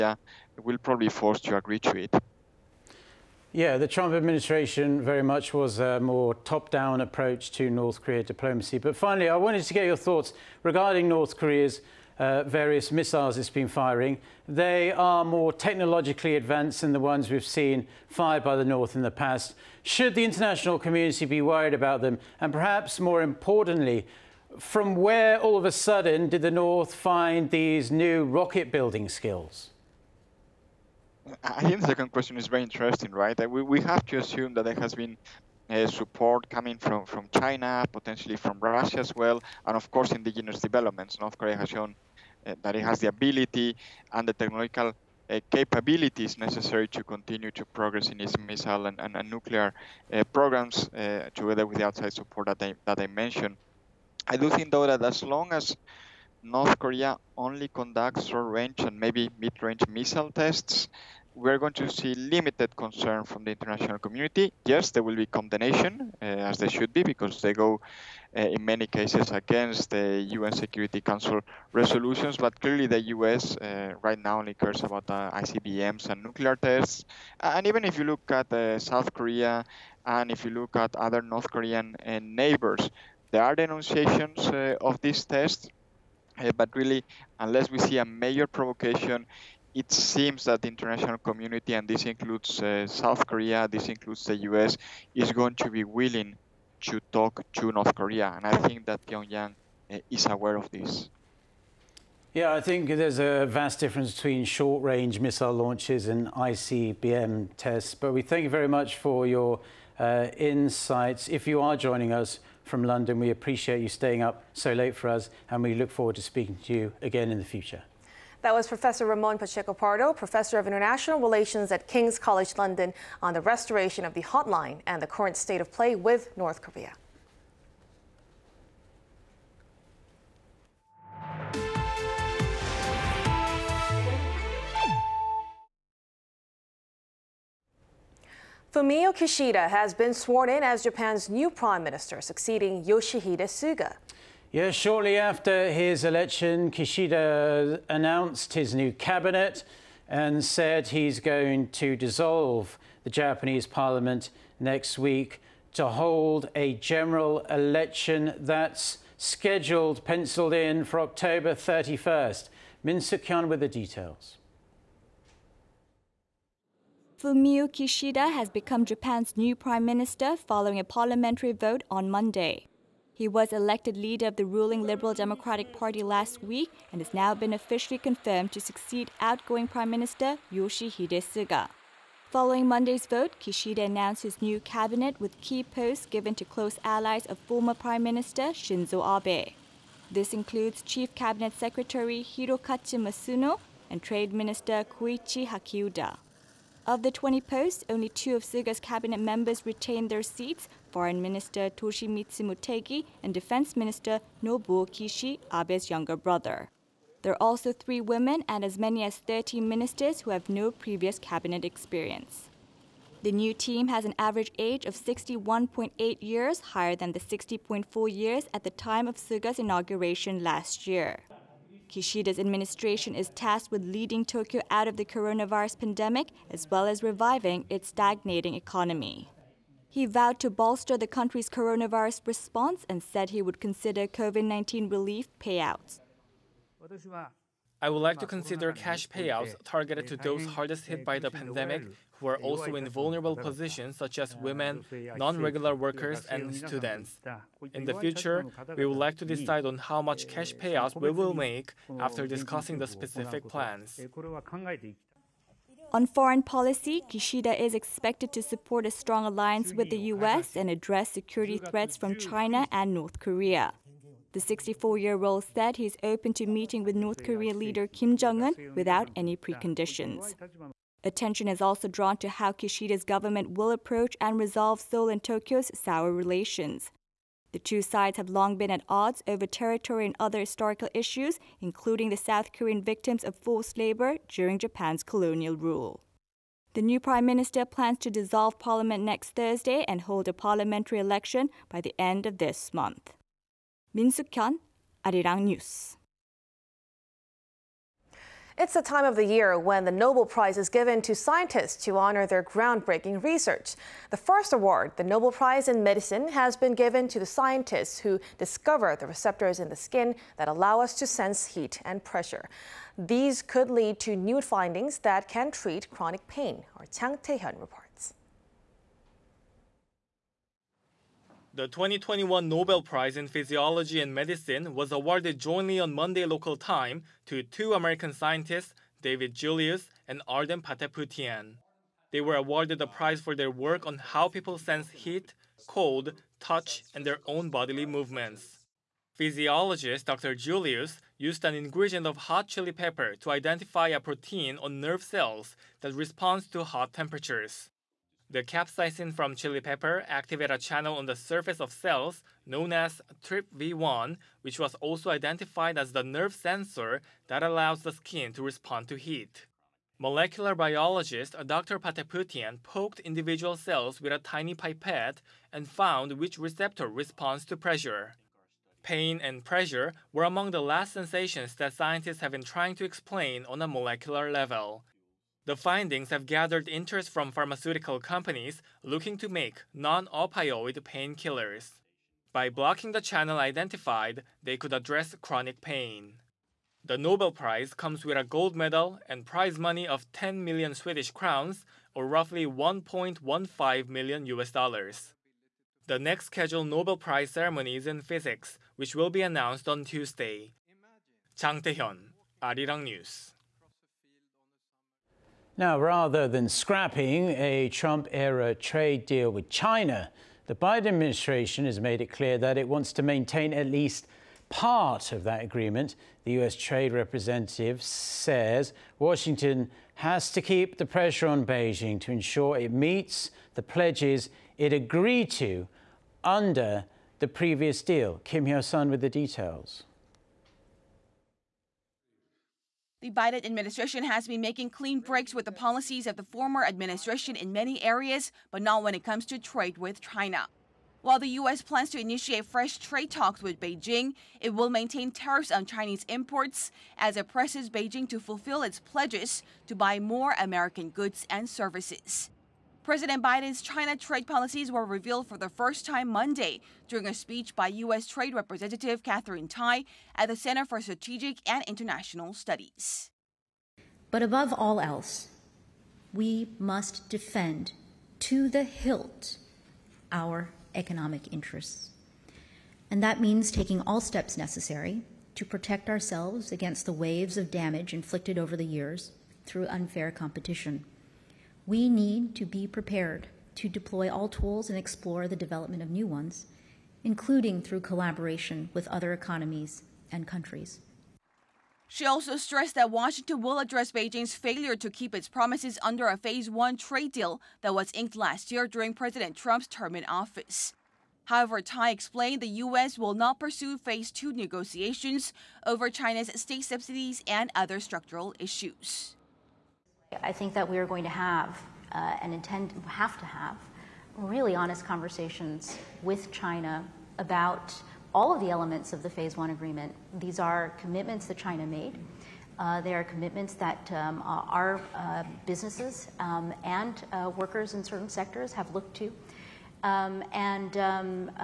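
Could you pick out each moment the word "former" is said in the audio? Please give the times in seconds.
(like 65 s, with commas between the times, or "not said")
187 s, 436 s.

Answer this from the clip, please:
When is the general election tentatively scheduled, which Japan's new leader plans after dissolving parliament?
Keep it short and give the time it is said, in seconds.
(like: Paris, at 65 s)
October 31st, at 161 s.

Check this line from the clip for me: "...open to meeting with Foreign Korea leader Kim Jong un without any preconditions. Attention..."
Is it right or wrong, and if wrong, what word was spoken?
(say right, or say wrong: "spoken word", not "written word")
wrong: "North", not "Foreign".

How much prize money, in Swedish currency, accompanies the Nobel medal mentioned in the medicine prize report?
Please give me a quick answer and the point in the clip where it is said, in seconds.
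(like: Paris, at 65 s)
10 million Swedish crowns, at 390 s.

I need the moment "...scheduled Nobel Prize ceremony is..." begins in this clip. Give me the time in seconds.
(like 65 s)
396 s.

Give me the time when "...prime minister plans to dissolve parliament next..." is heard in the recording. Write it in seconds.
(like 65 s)
287 s.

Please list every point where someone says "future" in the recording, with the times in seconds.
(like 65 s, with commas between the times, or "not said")
117 s, 247 s.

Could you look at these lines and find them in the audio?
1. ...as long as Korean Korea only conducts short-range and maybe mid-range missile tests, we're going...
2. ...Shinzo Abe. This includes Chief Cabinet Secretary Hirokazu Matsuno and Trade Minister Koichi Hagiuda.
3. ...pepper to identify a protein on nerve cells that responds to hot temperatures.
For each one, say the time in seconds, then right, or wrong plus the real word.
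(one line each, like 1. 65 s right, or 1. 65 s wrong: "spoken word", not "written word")
1. 55 s wrong: "North", not "Korean"
2. 188 s right
3. 342 s right.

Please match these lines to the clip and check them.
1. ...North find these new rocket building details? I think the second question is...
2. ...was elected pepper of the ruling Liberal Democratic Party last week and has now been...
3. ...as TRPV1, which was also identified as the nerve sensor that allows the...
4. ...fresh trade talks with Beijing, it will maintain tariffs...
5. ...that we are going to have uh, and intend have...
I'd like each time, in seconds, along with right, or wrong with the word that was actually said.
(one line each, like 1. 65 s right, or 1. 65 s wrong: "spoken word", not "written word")
1. 26 s wrong: "skills", not "details"
2. 173 s wrong: "leader", not "pepper"
3. 352 s right
4. 442 s right
5. 510 s right.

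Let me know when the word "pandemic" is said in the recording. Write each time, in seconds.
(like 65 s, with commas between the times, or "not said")
225 s, 241 s.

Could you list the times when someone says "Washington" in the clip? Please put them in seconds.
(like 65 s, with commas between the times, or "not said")
418 s, 492 s.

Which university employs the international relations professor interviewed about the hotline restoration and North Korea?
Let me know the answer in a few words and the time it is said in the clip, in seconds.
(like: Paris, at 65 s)
King's College London, at 121 s.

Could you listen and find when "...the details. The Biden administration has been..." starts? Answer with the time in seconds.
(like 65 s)
429 s.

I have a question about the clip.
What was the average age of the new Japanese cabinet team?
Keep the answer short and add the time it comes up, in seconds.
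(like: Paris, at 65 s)
61.8 years, at 214 s.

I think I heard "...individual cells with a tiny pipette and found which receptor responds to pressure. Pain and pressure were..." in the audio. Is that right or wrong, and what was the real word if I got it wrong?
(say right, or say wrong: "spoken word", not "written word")
right.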